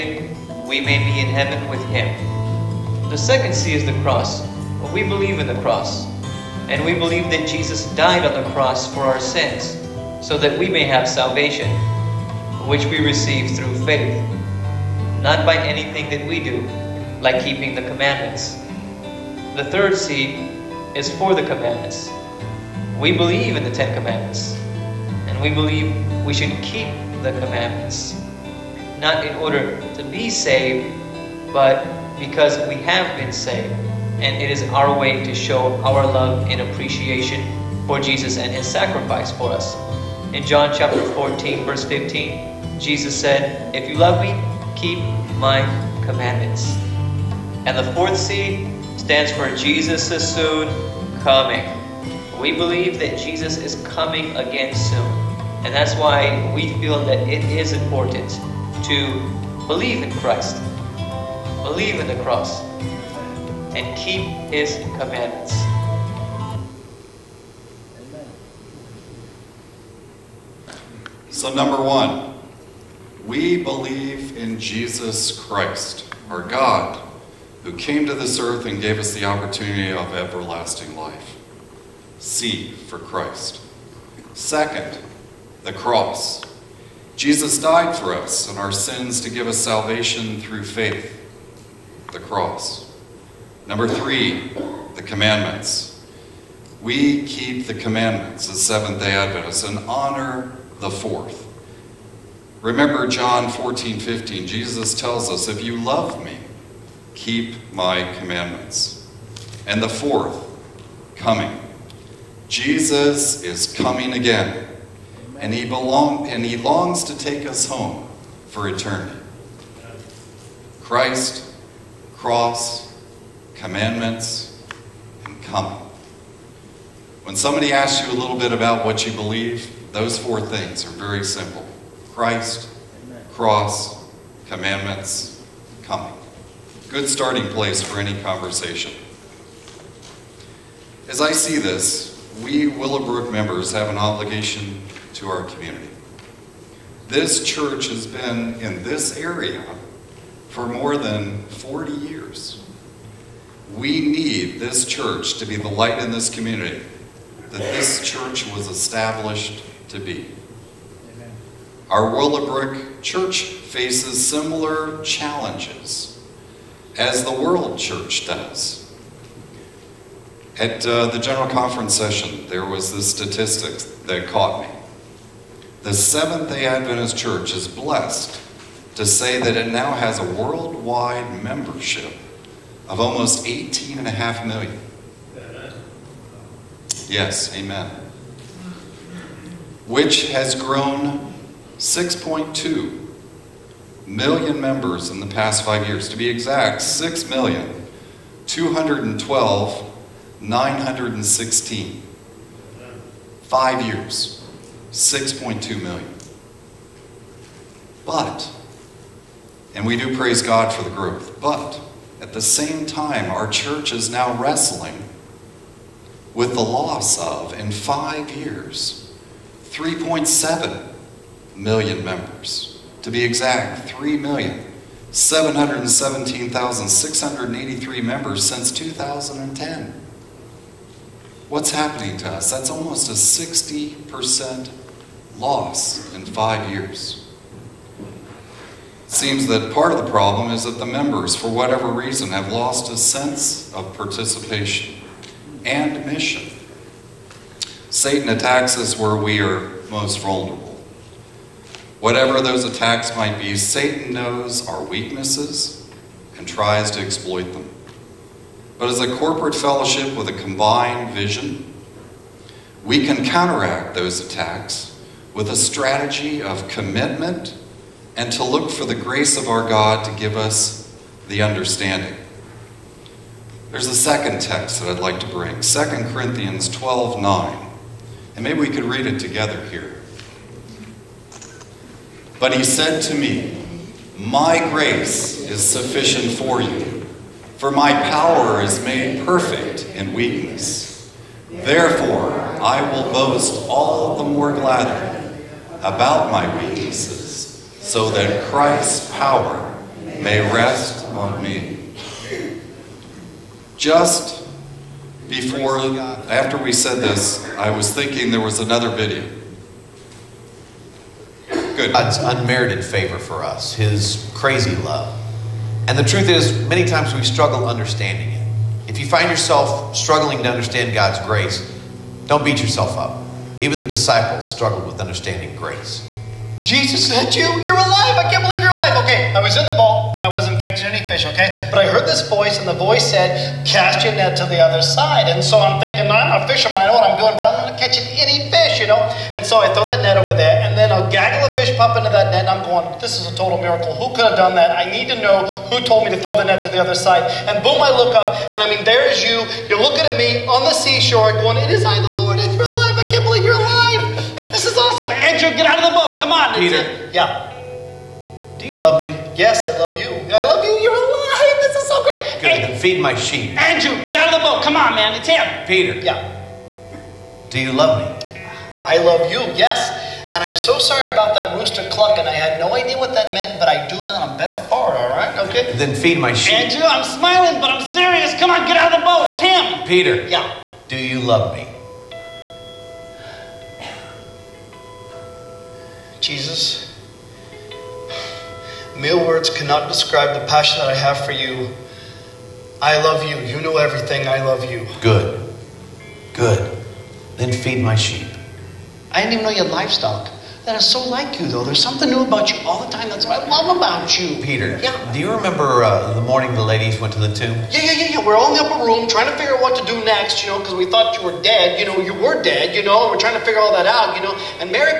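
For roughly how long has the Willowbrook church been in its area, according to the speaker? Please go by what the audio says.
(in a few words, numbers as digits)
more than 40 years.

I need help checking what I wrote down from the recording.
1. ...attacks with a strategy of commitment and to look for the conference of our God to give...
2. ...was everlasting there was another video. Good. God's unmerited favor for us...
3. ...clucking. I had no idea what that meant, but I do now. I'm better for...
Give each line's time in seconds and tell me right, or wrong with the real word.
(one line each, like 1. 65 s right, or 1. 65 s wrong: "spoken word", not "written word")
1. 264 s wrong: "grace", not "conference"
2. 307 s wrong: "thinking", not "everlasting"
3. 371 s right.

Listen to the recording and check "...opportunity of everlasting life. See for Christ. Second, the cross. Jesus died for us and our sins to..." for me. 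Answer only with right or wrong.
right.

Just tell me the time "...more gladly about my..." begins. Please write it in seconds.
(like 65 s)
294 s.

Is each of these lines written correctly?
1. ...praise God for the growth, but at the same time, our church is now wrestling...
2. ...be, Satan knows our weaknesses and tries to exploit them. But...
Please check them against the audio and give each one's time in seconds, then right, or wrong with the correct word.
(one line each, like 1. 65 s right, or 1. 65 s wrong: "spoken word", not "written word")
1. 210 s right
2. 253 s right.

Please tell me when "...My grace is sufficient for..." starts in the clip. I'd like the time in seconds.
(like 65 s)
284 s.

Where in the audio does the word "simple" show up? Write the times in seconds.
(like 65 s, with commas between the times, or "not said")
131 s.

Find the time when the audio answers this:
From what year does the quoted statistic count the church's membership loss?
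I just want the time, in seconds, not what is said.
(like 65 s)
228 s.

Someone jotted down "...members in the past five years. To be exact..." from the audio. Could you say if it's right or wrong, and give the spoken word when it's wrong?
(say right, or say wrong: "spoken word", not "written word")
right.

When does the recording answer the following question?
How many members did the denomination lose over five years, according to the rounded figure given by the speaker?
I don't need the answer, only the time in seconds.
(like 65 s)
219 s.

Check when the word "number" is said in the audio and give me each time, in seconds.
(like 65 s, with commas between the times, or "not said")
71 s, 93 s.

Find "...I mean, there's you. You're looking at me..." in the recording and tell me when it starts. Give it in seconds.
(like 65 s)
348 s.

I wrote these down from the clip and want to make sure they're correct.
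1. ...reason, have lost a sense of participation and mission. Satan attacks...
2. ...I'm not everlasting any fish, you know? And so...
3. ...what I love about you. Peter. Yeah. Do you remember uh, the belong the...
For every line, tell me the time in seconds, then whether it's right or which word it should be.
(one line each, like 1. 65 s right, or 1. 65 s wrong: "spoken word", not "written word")
1. 241 s right
2. 337 s wrong: "catching", not "everlasting"
3. 403 s wrong: "morning", not "belong".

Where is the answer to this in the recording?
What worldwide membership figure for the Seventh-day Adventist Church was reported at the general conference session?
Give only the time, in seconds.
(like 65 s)
183 s.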